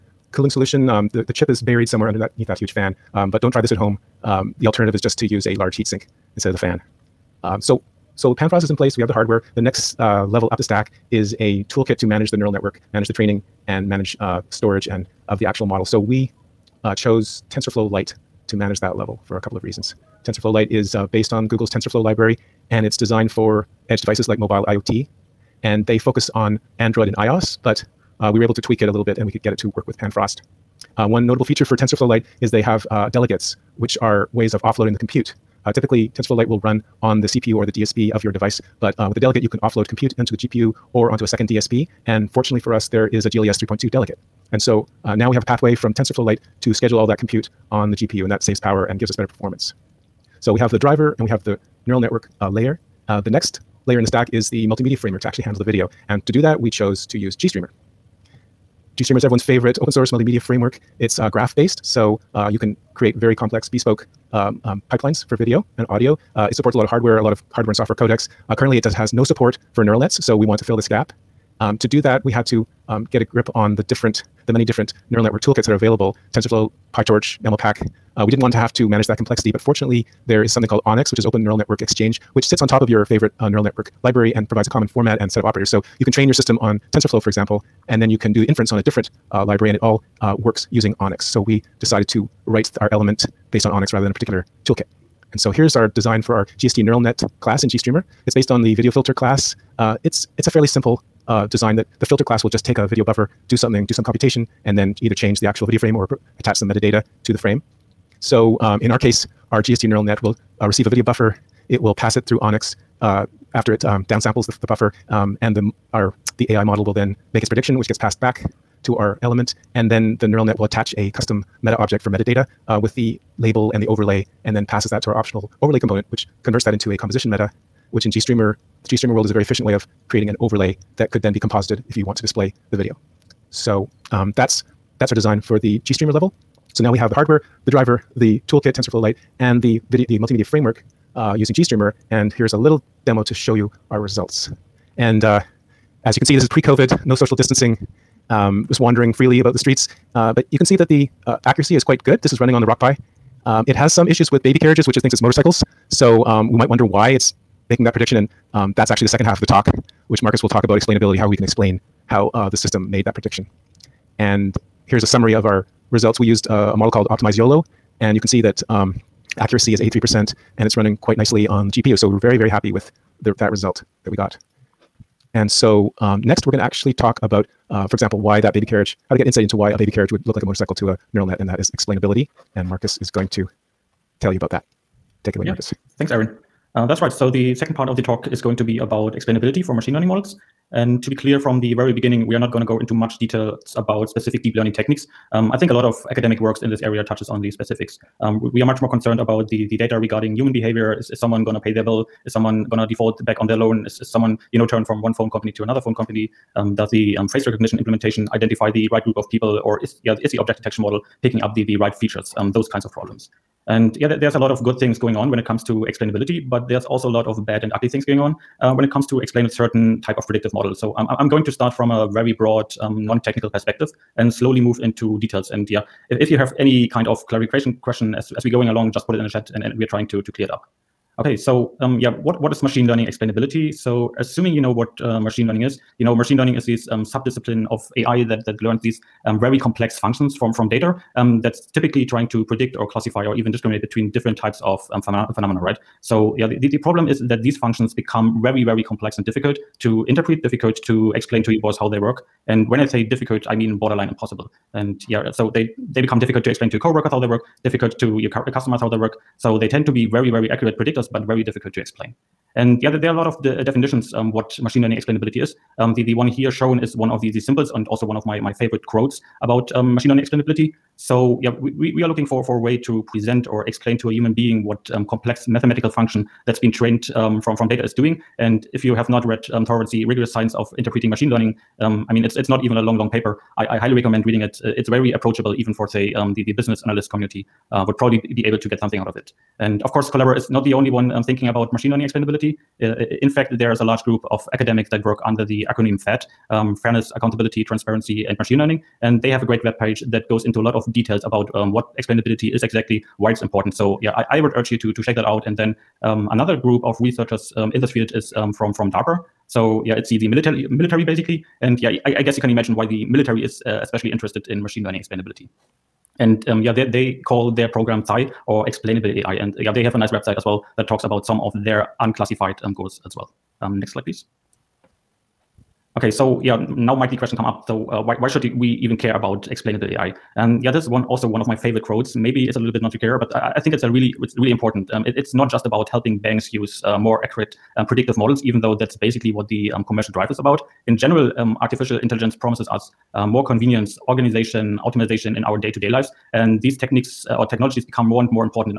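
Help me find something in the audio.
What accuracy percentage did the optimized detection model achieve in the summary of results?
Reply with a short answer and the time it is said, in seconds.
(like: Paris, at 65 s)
83%, at 169 s.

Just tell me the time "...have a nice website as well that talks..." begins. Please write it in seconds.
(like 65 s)
319 s.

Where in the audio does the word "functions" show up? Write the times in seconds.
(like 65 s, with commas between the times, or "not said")
239 s, 247 s, 275 s.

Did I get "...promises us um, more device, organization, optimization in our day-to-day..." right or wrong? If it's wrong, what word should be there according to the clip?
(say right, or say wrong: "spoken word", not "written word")
wrong: "convenience", not "device".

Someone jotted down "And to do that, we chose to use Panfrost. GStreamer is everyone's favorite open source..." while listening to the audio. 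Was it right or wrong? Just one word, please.
wrong.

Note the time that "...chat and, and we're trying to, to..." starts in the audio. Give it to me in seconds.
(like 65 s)
229 s.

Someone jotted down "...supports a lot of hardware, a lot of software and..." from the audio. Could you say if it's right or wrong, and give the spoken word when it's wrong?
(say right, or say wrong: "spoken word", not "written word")
wrong: "hardware", not "software".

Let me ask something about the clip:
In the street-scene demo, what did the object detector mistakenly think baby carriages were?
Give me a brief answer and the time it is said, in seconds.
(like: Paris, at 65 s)
motorcycles, at 155 s.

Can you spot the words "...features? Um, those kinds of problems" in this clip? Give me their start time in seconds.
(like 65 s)
211 s.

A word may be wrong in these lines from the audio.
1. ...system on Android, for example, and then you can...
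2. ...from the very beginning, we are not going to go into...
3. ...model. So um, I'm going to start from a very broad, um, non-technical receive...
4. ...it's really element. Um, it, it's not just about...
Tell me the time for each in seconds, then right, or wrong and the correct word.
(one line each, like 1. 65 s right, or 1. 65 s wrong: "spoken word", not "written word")
1. 86 s wrong: "TensorFlow", not "Android"
2. 191 s right
3. 220 s wrong: "perspective", not "receive"
4. 334 s wrong: "important", not "element".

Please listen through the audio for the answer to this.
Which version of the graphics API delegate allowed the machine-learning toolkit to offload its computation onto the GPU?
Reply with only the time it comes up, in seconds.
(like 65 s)
43 s.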